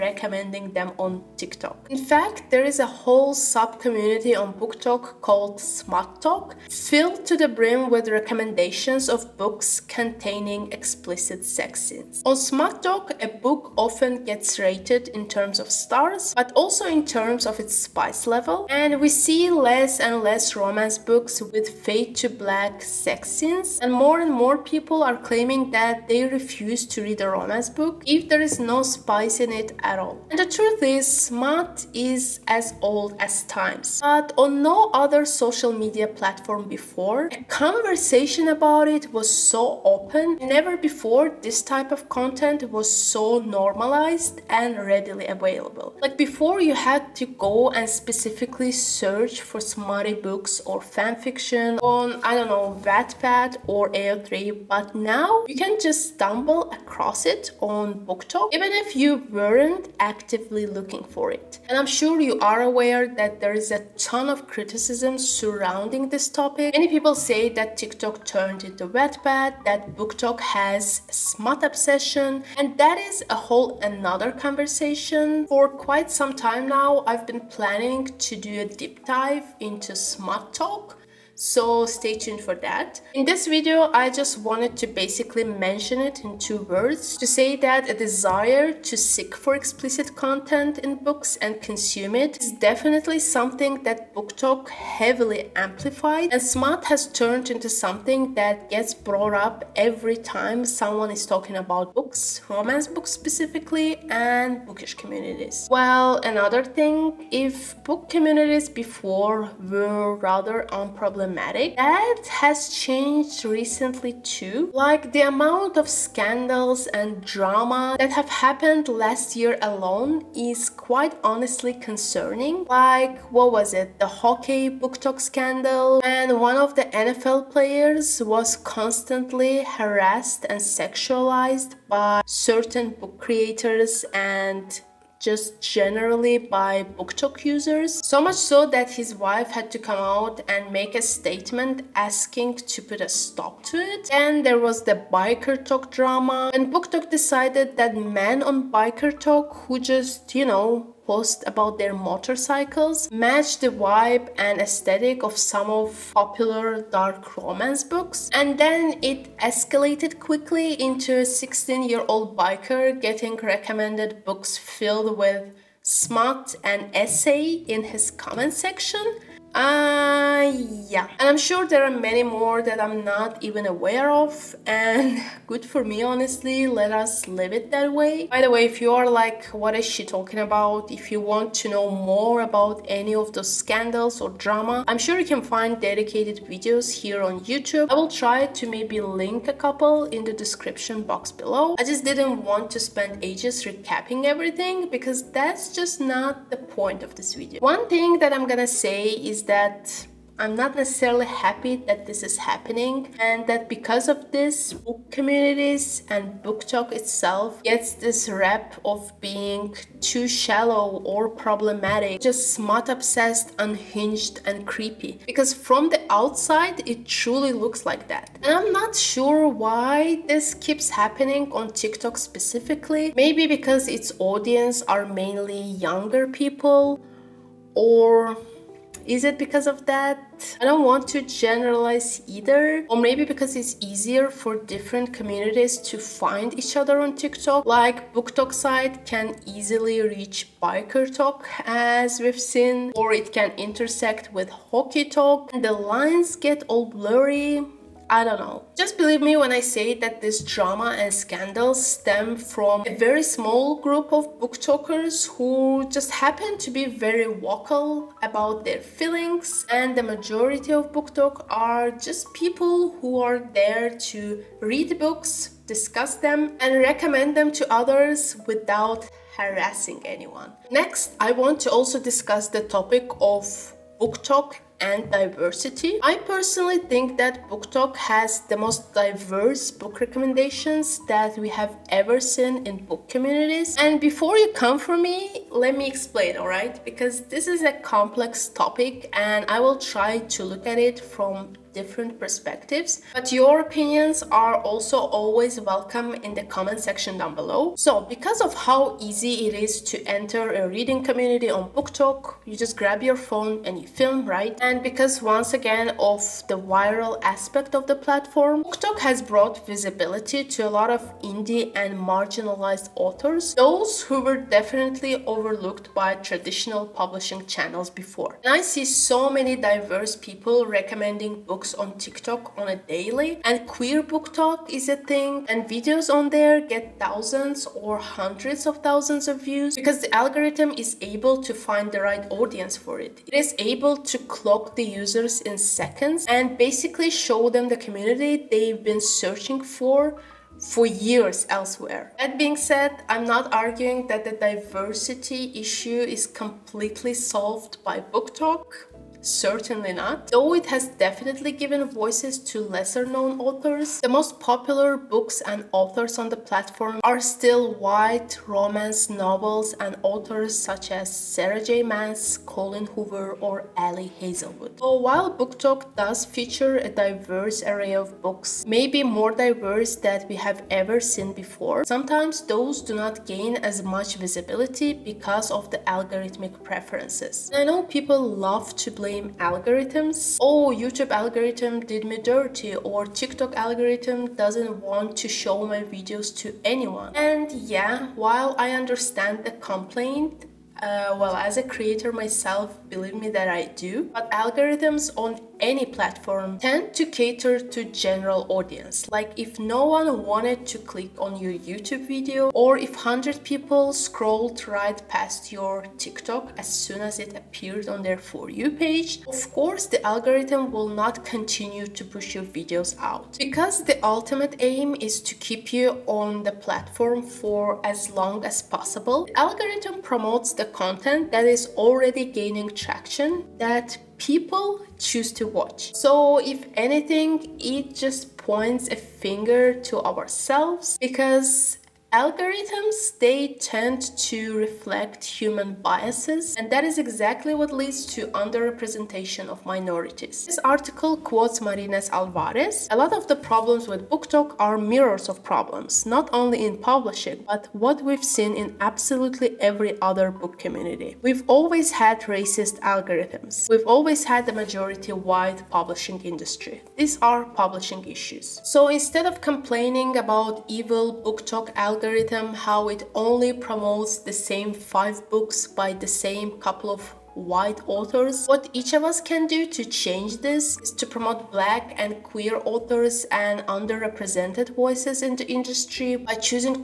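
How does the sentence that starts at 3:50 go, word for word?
I don't want to generalize either.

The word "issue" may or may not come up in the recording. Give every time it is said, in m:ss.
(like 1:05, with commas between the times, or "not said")
5:45, 7:38.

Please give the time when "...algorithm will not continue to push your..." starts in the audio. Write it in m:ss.
6:50.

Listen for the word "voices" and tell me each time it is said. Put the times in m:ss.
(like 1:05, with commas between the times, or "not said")
5:51, 7:54.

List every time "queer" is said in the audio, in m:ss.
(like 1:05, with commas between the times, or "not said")
5:23, 7:52.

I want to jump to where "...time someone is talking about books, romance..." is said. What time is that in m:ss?
1:40.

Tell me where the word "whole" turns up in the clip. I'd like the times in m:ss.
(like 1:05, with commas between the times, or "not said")
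0:02, 1:13.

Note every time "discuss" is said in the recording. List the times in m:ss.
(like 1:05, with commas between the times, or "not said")
4:25, 4:31.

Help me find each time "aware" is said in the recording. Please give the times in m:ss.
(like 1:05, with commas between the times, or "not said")
1:02, 2:53.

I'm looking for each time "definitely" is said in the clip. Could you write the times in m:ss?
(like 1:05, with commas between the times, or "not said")
1:32, 5:14, 5:50.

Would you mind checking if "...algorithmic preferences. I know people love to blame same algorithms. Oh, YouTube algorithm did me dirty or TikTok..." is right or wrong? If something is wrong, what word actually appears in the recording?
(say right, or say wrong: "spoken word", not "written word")
right.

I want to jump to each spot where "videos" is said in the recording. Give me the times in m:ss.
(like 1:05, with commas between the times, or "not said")
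1:23, 3:06, 3:17, 5:25, 6:25, 6:42, 6:52.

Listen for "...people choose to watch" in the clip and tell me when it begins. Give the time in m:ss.
7:04.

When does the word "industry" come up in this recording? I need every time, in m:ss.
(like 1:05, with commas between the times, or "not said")
7:36, 7:55.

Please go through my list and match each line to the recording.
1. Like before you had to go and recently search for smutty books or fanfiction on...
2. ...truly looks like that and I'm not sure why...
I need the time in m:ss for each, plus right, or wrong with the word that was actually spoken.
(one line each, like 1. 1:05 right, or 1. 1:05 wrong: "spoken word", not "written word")
1. 0:46 wrong: "specifically", not "recently"
2. 3:37 right.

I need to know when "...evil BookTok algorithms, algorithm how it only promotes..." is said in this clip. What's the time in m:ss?
7:40.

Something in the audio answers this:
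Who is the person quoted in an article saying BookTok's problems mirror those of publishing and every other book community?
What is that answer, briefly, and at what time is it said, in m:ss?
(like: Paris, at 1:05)
Marines Alvarez, at 7:21.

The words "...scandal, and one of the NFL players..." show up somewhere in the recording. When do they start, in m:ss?
2:05.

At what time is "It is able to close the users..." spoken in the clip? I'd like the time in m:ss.
5:33.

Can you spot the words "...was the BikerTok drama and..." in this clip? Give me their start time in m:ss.
2:24.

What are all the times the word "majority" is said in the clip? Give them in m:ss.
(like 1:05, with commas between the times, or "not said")
4:20, 7:34.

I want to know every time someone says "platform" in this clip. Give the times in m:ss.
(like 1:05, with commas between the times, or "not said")
0:36, 5:07, 5:56, 6:35, 6:56.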